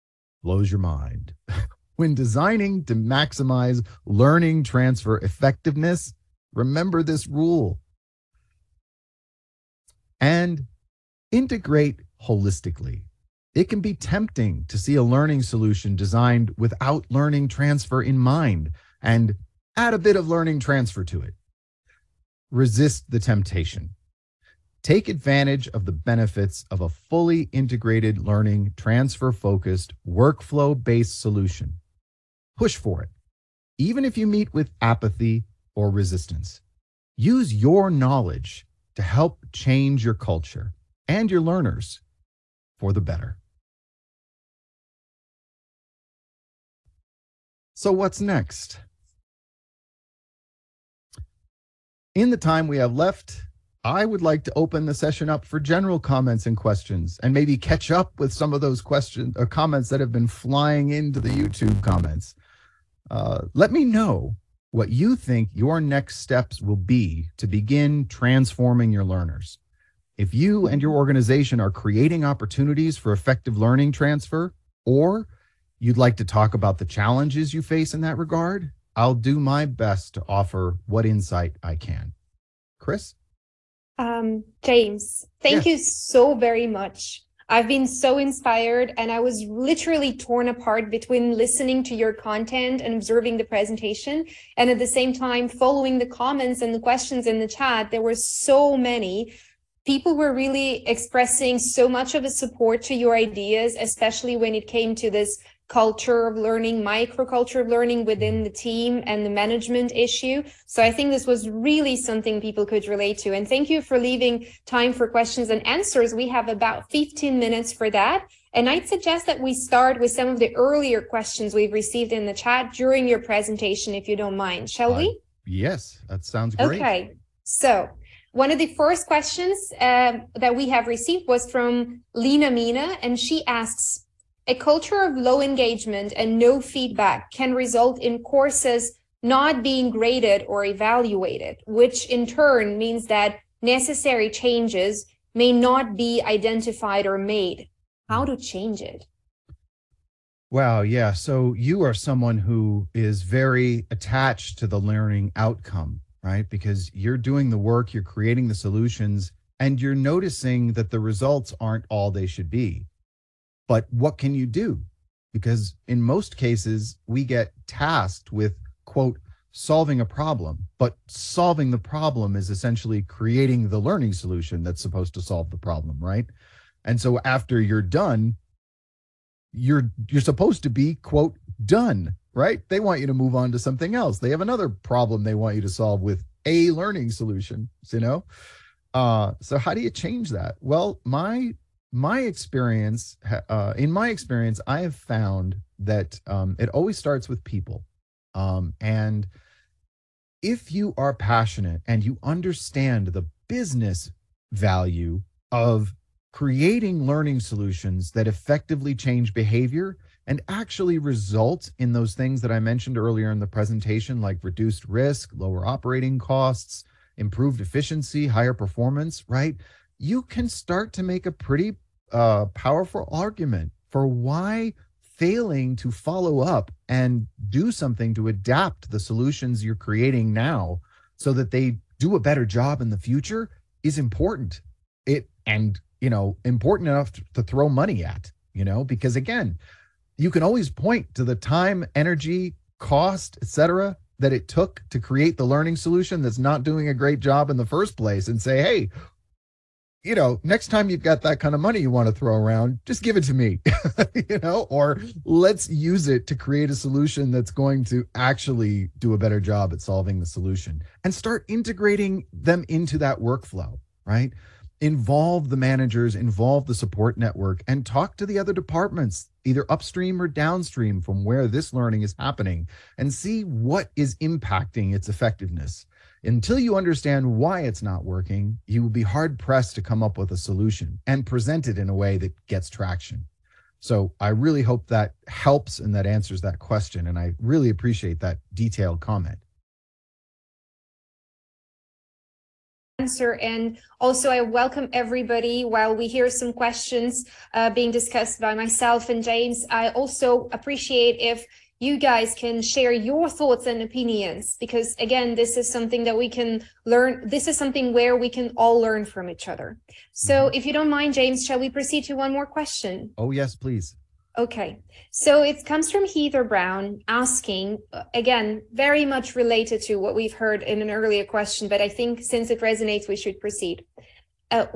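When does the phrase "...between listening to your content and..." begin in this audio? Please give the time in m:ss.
1:30.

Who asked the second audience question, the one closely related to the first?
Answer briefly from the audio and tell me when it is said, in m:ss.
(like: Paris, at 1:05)
Heather Brown, at 5:16.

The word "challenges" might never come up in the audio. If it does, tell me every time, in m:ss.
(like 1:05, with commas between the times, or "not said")
1:16.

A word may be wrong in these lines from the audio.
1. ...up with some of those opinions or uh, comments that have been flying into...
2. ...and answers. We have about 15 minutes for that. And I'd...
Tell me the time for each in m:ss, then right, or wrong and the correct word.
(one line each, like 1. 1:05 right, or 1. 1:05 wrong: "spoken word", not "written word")
1. 0:57 wrong: "questions", not "opinions"
2. 1:55 right.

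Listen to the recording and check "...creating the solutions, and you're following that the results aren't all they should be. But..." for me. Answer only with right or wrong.
wrong.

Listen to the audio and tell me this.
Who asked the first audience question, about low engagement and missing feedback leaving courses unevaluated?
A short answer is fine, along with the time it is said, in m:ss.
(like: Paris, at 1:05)
Lena Mina, at 2:12.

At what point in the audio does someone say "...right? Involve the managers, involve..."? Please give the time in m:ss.
4:24.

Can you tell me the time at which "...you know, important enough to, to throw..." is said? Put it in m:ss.
3:56.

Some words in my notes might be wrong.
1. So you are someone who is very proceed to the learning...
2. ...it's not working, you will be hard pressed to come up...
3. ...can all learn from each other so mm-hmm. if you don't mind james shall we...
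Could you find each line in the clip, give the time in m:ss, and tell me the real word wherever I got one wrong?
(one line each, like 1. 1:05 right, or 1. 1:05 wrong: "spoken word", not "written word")
1. 2:31 wrong: "attached", not "proceed"
2. 4:37 right
3. 5:08 right.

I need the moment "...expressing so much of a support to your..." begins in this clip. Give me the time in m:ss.
1:40.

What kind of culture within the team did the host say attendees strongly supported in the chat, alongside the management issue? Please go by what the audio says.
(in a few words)
microculture of learning.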